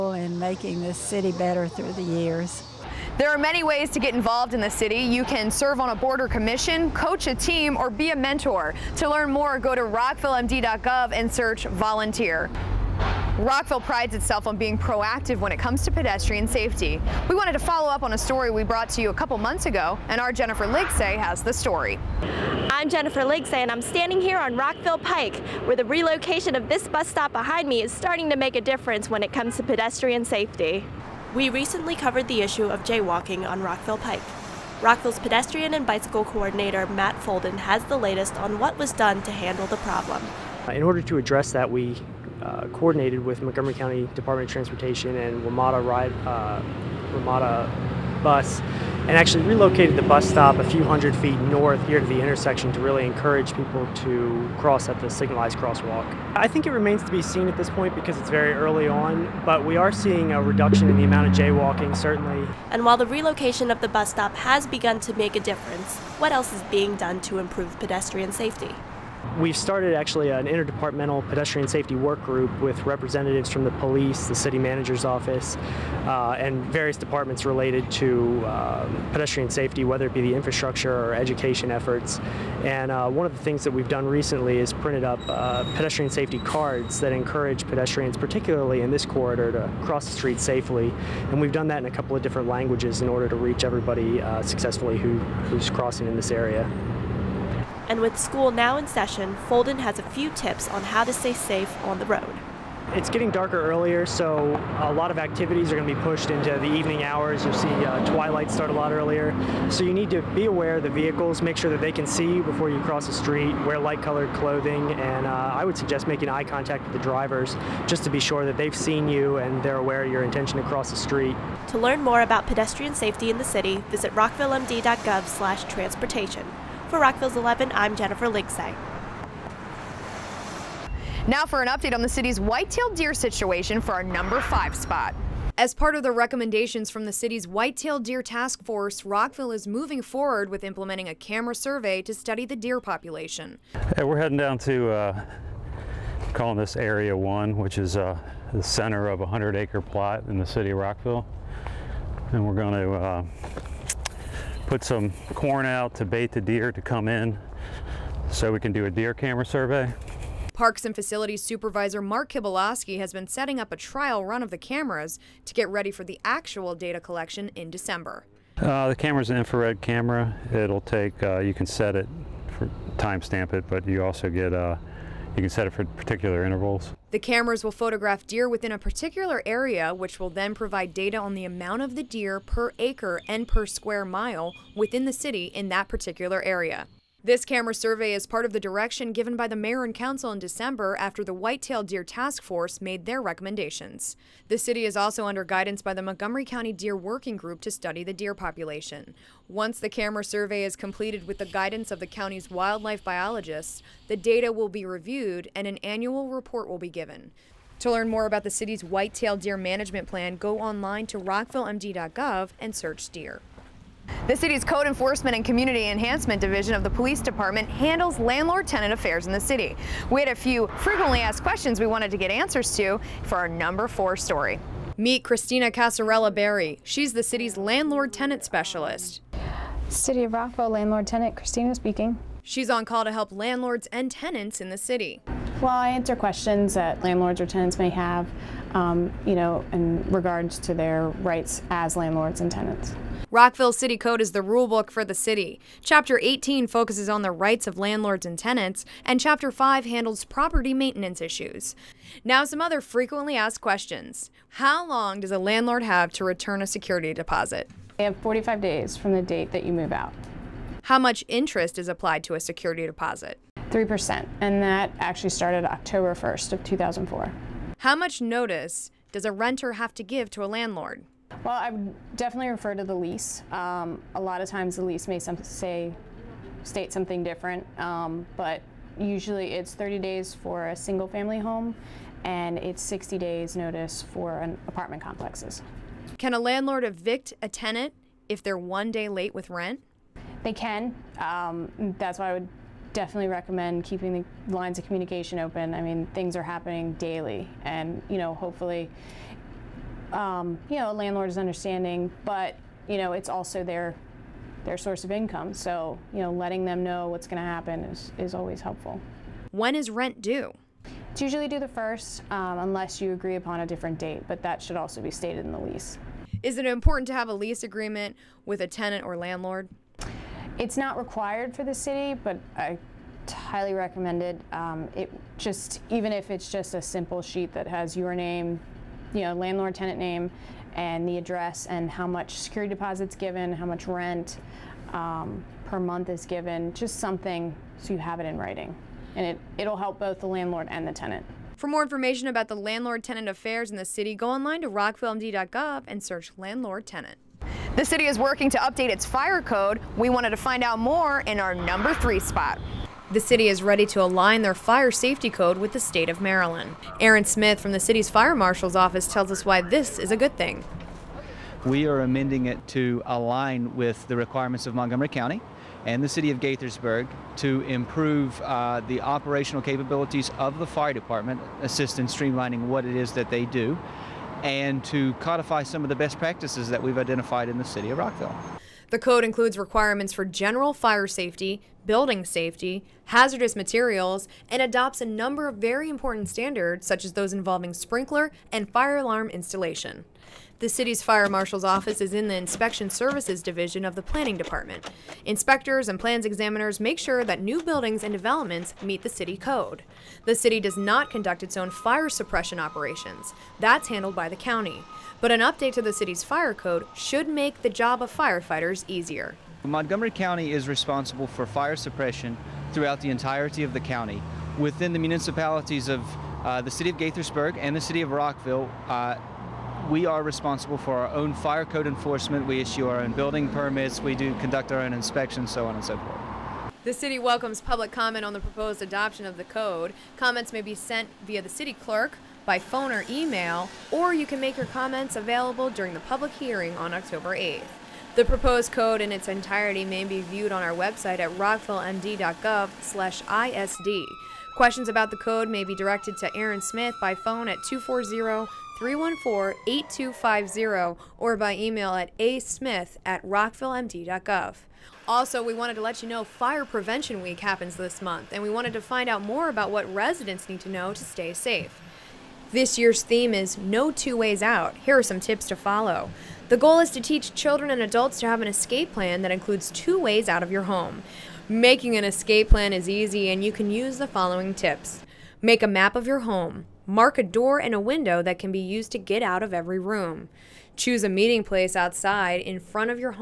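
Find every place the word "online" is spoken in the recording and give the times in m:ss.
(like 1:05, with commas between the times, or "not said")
3:30, 5:44.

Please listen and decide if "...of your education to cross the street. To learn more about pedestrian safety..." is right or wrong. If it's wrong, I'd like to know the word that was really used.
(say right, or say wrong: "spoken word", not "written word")
wrong: "intention", not "education".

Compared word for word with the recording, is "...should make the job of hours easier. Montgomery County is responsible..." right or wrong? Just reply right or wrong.
wrong.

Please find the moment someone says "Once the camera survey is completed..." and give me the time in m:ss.
3:19.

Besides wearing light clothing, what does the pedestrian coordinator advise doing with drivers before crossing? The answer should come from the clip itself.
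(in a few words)
Making eye contact.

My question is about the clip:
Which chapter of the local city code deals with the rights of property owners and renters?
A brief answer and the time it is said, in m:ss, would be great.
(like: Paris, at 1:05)
Chapter 18, at 4:05.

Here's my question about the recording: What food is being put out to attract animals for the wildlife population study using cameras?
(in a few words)
Corn.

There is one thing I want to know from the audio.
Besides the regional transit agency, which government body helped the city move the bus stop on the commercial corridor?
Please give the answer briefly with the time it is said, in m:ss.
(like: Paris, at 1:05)
Montgomery County Department of Transportation, at 0:43.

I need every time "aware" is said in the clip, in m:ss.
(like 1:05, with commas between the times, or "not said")
1:50, 1:59.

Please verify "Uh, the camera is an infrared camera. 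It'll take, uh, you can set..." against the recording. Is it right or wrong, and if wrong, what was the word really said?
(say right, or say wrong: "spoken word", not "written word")
right.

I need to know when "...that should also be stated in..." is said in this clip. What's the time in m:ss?
5:14.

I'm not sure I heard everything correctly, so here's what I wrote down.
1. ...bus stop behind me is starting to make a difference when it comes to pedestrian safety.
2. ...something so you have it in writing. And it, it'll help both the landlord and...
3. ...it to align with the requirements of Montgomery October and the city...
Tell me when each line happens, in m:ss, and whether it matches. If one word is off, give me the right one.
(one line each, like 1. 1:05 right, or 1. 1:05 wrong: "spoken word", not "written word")
1. 0:26 right
2. 5:36 right
3. 6:02 wrong: "County", not "October".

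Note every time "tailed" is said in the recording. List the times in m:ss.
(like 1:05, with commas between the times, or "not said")
2:12, 2:17, 3:11, 3:28.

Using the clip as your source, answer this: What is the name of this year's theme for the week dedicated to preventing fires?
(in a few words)
No Two Ways Out.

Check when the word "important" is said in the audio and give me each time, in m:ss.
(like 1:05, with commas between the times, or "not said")
5:16, 6:25.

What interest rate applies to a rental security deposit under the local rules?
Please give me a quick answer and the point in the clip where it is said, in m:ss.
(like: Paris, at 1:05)
3%, at 4:23.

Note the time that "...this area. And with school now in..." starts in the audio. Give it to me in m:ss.
1:36.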